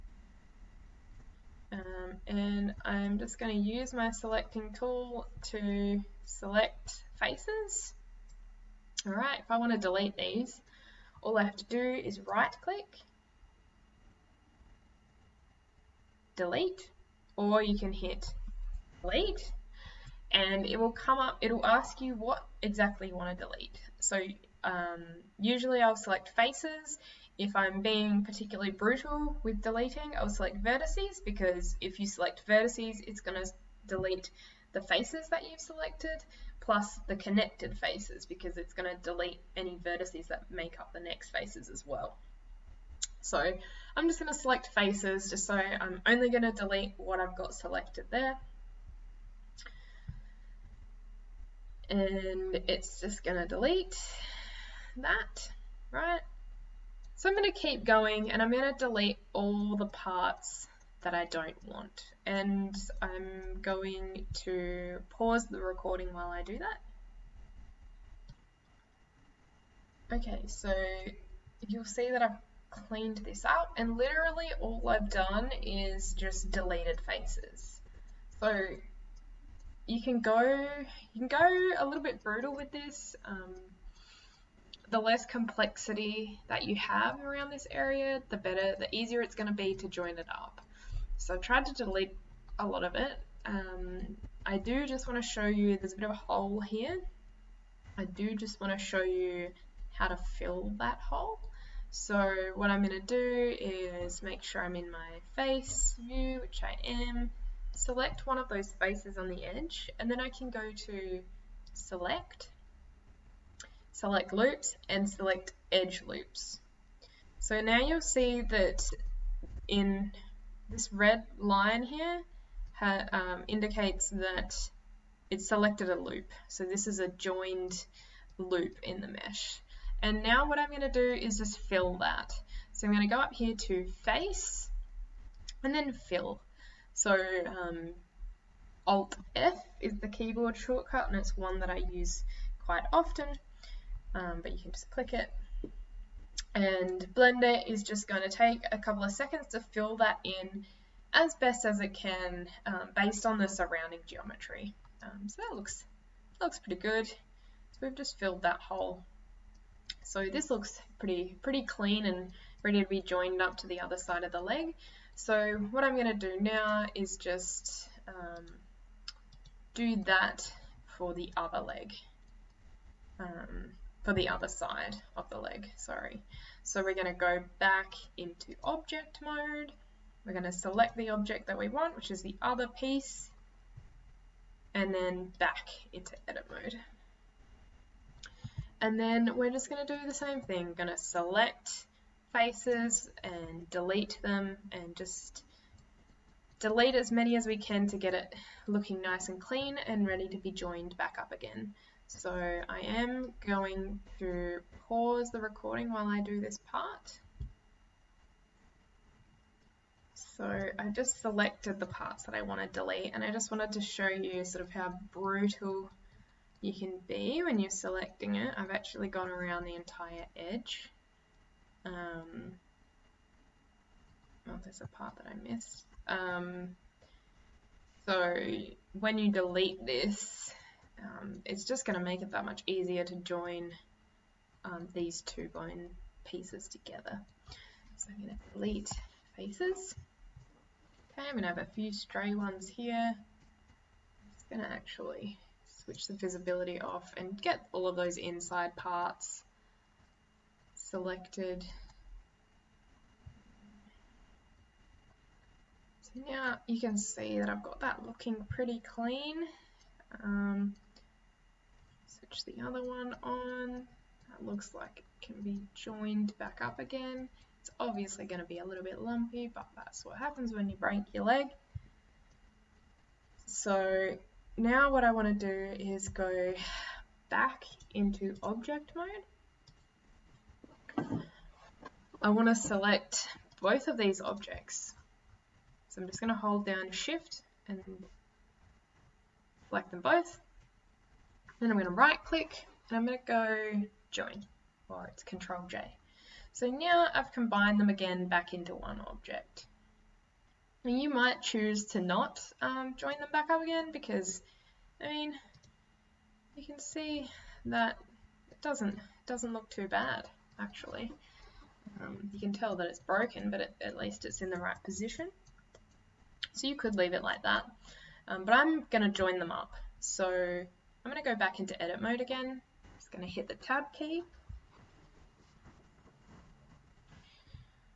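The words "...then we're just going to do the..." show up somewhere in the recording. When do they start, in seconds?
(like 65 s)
188 s.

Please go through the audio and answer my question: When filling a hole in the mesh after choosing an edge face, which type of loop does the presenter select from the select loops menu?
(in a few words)
edge loops.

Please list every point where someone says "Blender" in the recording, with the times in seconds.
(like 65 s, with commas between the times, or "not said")
147 s.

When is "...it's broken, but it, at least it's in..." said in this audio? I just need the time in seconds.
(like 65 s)
312 s.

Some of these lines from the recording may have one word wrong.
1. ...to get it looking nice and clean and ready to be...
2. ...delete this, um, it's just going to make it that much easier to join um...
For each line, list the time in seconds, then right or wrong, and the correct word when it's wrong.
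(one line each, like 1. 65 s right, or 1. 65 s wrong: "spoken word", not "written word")
1. 197 s right
2. 229 s right.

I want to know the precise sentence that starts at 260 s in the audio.
Um, switch the other one on.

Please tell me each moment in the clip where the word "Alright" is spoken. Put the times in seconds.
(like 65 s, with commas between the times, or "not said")
9 s.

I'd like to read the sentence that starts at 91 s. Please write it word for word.
So I've tried to delete a lot of it.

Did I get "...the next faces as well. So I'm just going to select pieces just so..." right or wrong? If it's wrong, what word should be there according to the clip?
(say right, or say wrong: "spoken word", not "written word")
wrong: "faces", not "pieces".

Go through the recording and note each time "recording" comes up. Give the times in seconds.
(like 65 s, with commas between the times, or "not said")
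65 s, 205 s.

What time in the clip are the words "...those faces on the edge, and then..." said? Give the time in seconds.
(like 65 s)
108 s.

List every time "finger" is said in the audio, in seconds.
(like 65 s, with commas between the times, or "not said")
not said.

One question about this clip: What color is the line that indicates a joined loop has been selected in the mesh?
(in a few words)
red.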